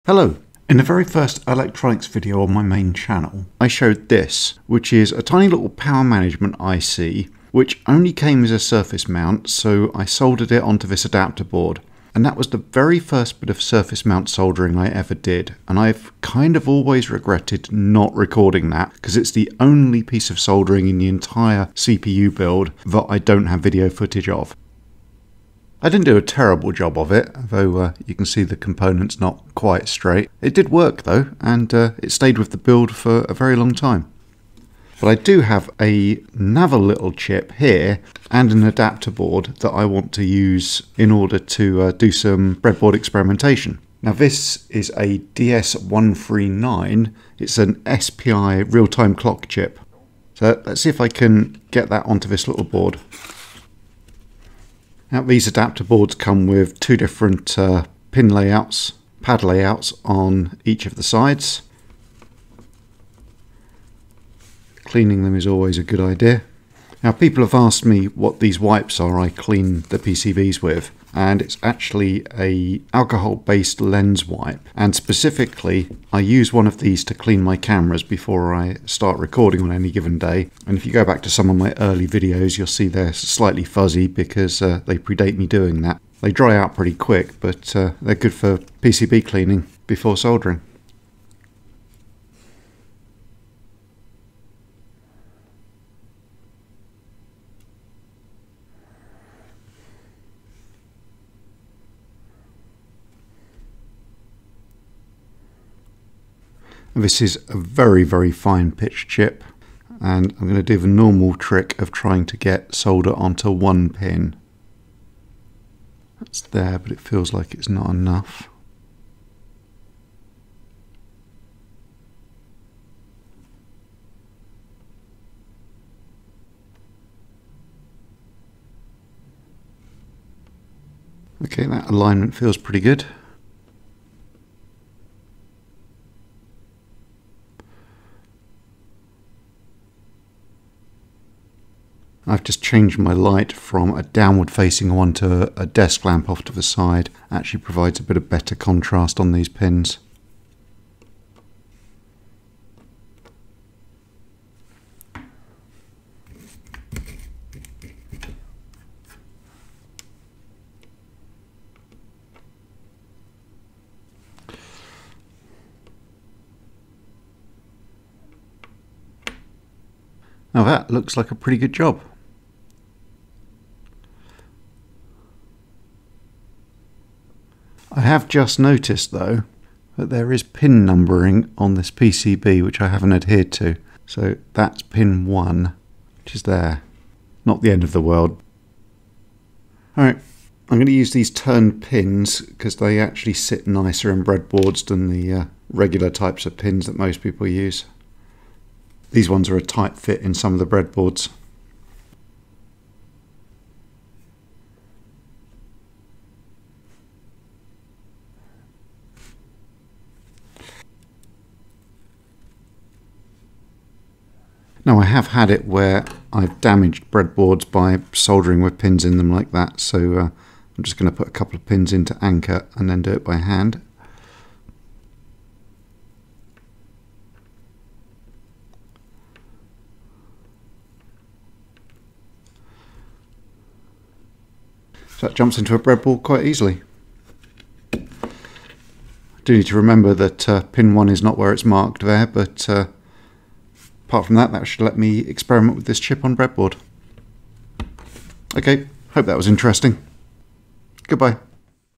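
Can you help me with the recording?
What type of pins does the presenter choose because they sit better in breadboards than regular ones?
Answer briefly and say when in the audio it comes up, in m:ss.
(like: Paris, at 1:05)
turned pins, at 3:11.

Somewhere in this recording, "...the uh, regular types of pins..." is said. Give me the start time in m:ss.
3:15.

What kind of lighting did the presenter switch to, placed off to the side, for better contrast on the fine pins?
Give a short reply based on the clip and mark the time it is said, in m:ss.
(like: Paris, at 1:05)
desk lamp, at 2:25.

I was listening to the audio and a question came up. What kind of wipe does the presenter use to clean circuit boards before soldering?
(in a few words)
alcohol-based lens wipe.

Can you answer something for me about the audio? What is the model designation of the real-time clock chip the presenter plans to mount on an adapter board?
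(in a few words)
DS139.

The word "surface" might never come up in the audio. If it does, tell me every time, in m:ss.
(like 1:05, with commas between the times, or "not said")
0:08, 0:13.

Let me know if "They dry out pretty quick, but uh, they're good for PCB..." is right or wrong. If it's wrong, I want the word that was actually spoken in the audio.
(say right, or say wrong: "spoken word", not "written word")
right.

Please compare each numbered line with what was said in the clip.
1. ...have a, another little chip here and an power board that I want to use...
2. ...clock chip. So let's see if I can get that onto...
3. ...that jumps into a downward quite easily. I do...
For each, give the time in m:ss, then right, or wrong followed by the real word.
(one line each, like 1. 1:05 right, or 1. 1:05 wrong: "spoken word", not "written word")
1. 0:35 wrong: "adapter", not "power"
2. 0:49 right
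3. 3:55 wrong: "breadboard", not "downward".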